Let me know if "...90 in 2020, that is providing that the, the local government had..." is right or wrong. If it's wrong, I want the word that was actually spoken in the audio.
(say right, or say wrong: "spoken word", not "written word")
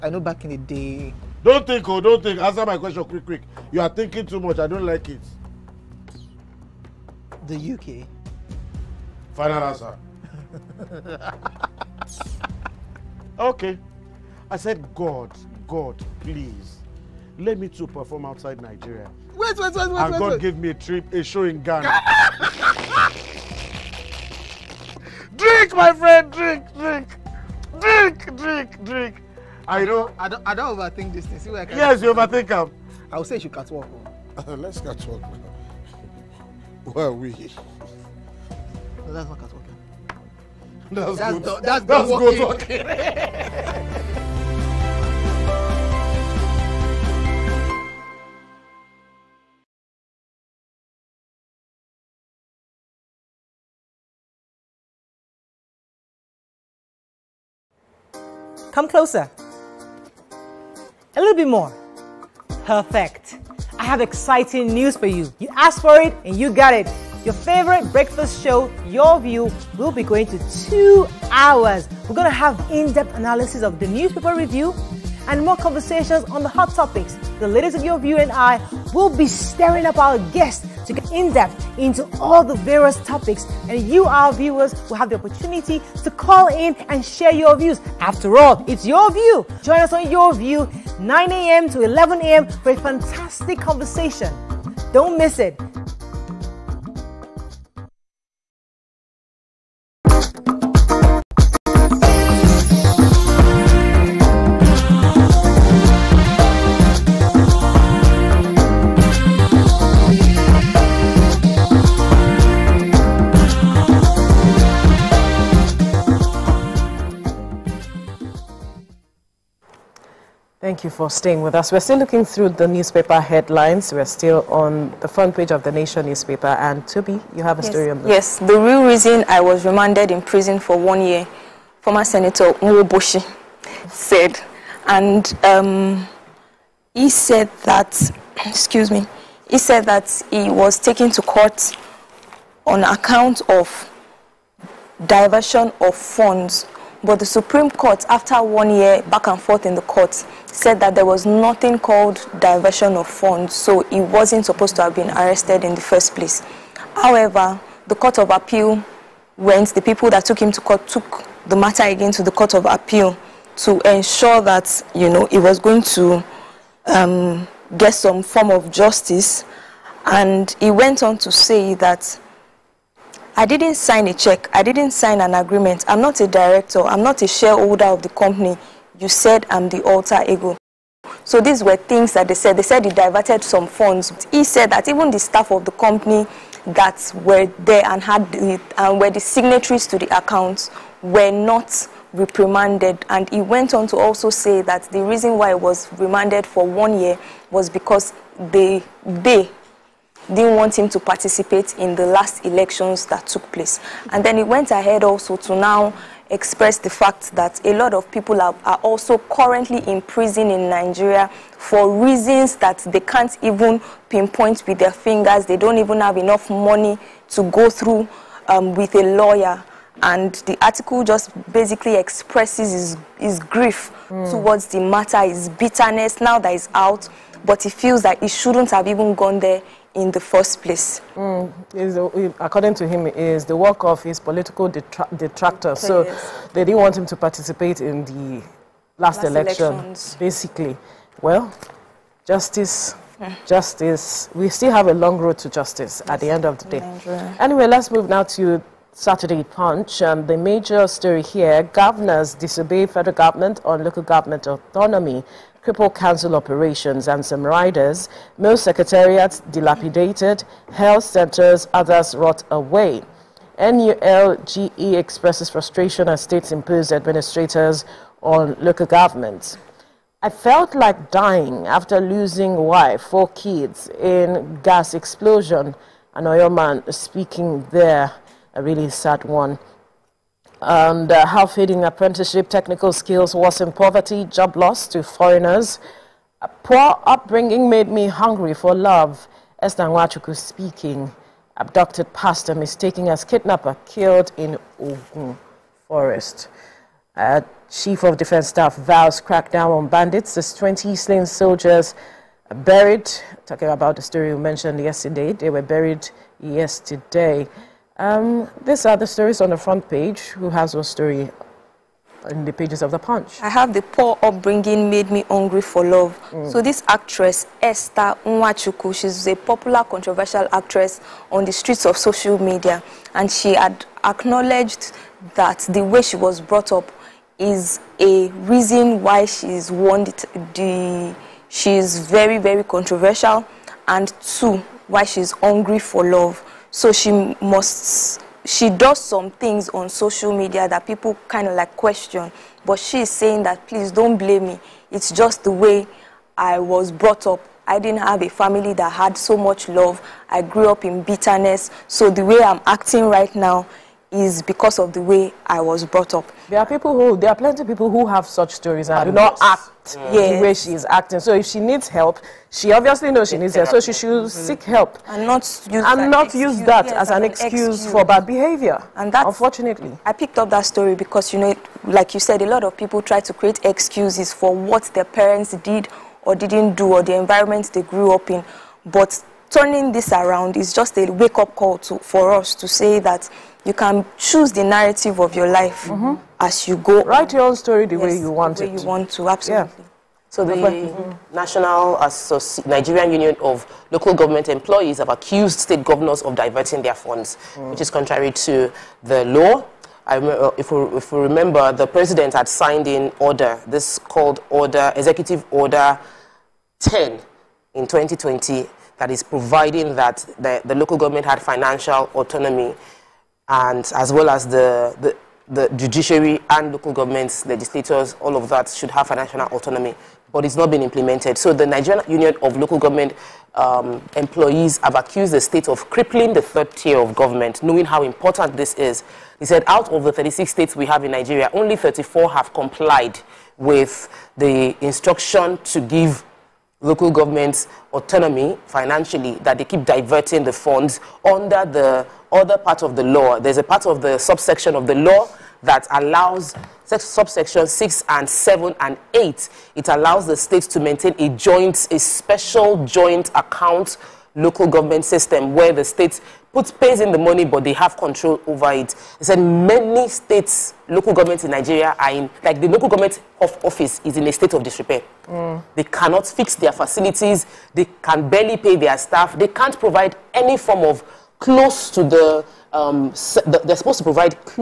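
wrong: "10", not "90".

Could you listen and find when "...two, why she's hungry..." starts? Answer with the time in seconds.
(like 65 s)
334 s.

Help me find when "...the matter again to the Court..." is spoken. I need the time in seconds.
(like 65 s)
161 s.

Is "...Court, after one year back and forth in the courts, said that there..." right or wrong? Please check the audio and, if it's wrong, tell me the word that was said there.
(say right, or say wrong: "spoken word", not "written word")
right.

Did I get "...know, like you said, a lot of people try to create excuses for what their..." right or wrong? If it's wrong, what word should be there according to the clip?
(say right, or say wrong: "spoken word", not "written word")
right.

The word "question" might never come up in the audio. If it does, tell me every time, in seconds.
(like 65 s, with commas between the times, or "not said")
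2 s, 341 s.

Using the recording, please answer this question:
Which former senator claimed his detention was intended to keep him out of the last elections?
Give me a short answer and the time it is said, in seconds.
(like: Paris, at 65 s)
Nwoboshi, at 132 s.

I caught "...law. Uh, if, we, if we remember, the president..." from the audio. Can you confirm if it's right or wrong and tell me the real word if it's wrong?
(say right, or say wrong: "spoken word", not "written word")
right.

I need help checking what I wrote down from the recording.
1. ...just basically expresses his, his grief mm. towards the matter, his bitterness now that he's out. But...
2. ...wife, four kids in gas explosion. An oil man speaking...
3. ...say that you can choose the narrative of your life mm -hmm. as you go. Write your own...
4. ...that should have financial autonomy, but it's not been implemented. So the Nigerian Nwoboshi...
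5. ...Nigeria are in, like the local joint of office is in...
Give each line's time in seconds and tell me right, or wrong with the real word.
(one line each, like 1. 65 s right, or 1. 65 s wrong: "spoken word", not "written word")
1. 221 s right
2. 272 s right
3. 382 s right
4. 418 s wrong: "Union", not "Nwoboshi"
5. 461 s wrong: "government", not "joint".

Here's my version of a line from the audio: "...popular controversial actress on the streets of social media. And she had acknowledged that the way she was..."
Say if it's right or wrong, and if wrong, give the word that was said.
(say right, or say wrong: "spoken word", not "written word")
right.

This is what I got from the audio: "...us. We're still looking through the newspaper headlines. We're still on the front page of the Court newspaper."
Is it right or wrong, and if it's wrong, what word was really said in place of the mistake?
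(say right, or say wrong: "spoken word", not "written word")
wrong: "Nation", not "Court".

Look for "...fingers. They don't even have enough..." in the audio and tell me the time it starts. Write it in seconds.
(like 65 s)
214 s.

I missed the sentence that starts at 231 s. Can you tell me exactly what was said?
Mm, according to him, is the work of his political detra detractors.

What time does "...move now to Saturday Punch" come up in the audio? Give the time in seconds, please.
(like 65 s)
247 s.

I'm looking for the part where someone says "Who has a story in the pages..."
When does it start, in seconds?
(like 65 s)
310 s.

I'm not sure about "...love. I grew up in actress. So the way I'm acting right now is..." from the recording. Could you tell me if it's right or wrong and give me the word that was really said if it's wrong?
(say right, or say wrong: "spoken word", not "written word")
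wrong: "bitterness", not "actress".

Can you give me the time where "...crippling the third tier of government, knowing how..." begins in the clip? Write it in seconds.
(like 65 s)
425 s.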